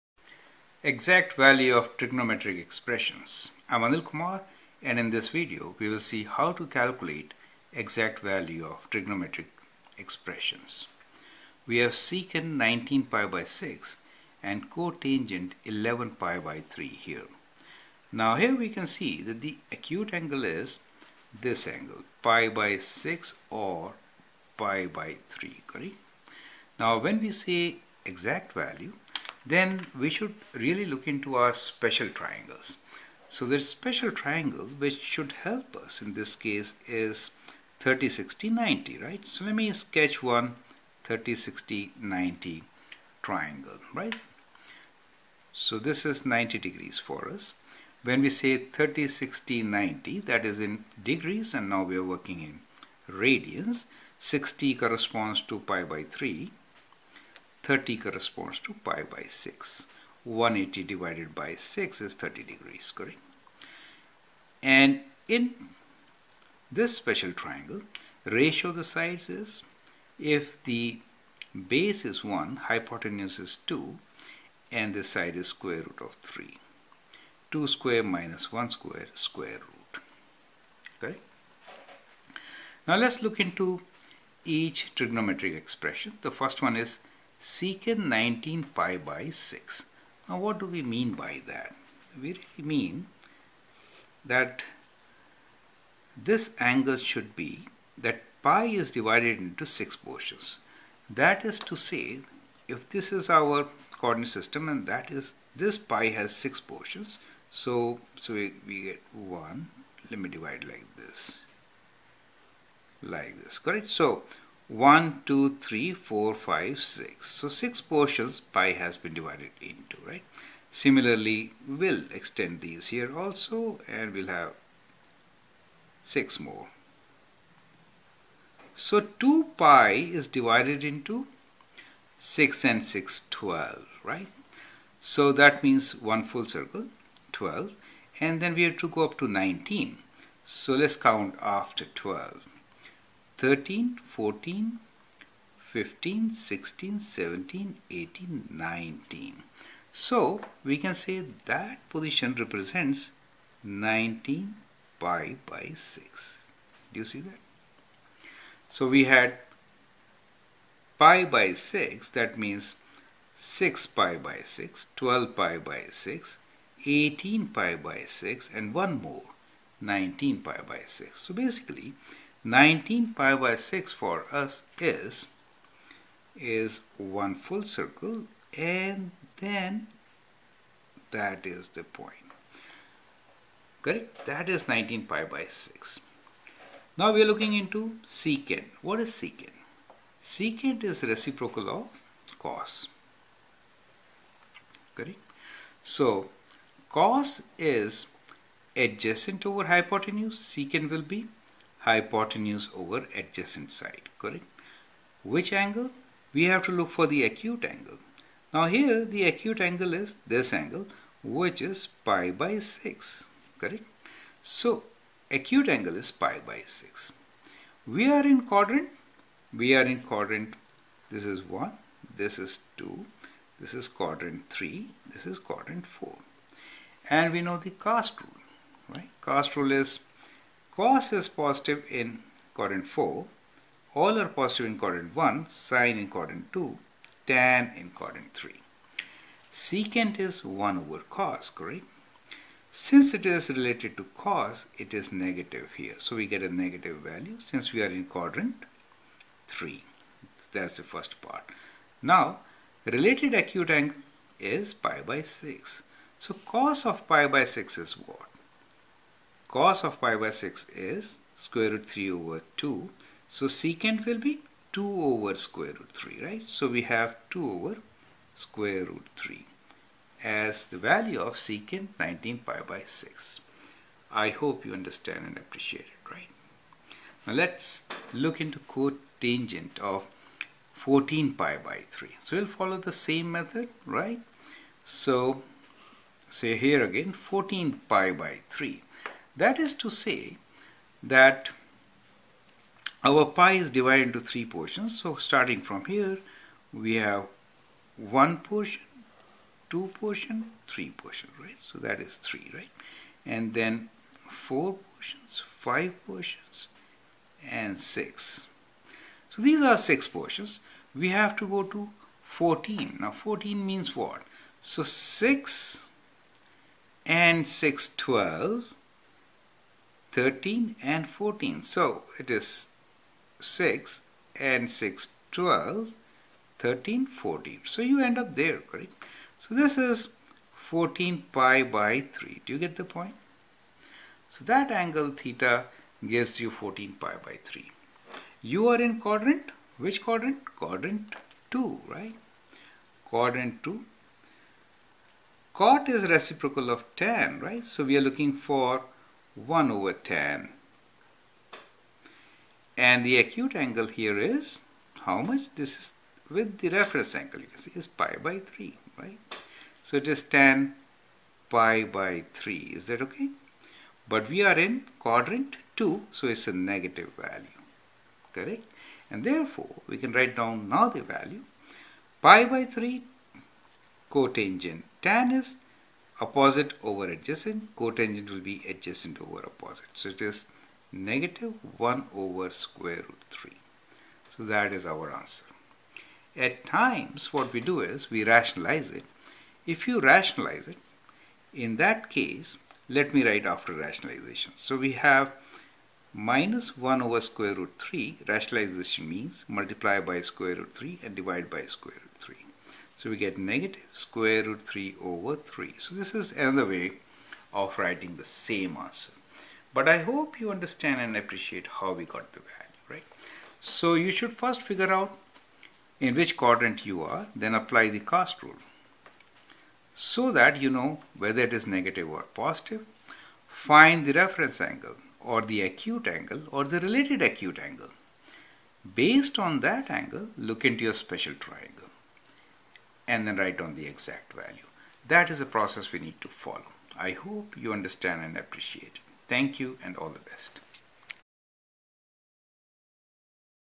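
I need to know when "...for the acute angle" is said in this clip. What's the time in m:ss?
3:26.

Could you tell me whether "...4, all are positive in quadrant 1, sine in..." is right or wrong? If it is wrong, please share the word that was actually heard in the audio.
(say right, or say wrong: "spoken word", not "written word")
right.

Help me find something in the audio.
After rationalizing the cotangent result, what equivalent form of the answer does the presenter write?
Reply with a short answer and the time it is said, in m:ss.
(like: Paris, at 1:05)
negative square root 3 over 3, at 6:43.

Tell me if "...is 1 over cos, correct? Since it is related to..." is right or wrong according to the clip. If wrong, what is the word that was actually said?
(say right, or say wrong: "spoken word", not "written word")
right.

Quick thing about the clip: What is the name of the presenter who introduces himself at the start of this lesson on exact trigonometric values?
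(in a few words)
Anil Kumar.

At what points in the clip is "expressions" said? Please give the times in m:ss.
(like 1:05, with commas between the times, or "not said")
0:02, 0:09, 1:25.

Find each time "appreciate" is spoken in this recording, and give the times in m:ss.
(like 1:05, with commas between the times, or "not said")
4:35, 6:51, 7:18.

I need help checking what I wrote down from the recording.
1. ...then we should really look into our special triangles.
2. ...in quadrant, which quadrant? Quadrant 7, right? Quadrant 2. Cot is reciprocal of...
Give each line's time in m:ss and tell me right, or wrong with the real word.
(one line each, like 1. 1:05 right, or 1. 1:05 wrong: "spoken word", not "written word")
1. 0:29 right
2. 5:38 wrong: "2", not "7".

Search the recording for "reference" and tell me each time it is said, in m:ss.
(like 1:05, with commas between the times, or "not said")
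5:56, 7:04.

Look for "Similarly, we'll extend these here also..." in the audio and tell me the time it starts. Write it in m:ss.
2:00.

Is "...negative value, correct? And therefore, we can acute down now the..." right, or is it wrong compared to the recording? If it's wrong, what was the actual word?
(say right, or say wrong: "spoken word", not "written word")
wrong: "write", not "acute".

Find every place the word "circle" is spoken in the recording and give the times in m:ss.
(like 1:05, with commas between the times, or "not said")
2:16, 2:57.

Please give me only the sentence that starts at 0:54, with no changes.
60 corresponds to pi by 3 30 corresponds to pi by 6.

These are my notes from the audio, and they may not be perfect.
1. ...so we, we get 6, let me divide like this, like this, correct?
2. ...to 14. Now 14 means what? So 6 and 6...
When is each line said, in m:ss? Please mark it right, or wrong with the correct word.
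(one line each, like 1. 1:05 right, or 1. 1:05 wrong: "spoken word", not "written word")
1. 1:48 wrong: "1", not "6"
2. 5:11 right.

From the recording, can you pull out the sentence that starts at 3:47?
And we know the cast rule, right?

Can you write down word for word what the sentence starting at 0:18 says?
Now here we can see that the acute angle is this angle pi by 6 or pi by 3 correct.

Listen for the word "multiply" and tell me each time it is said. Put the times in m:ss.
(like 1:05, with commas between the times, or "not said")
6:39.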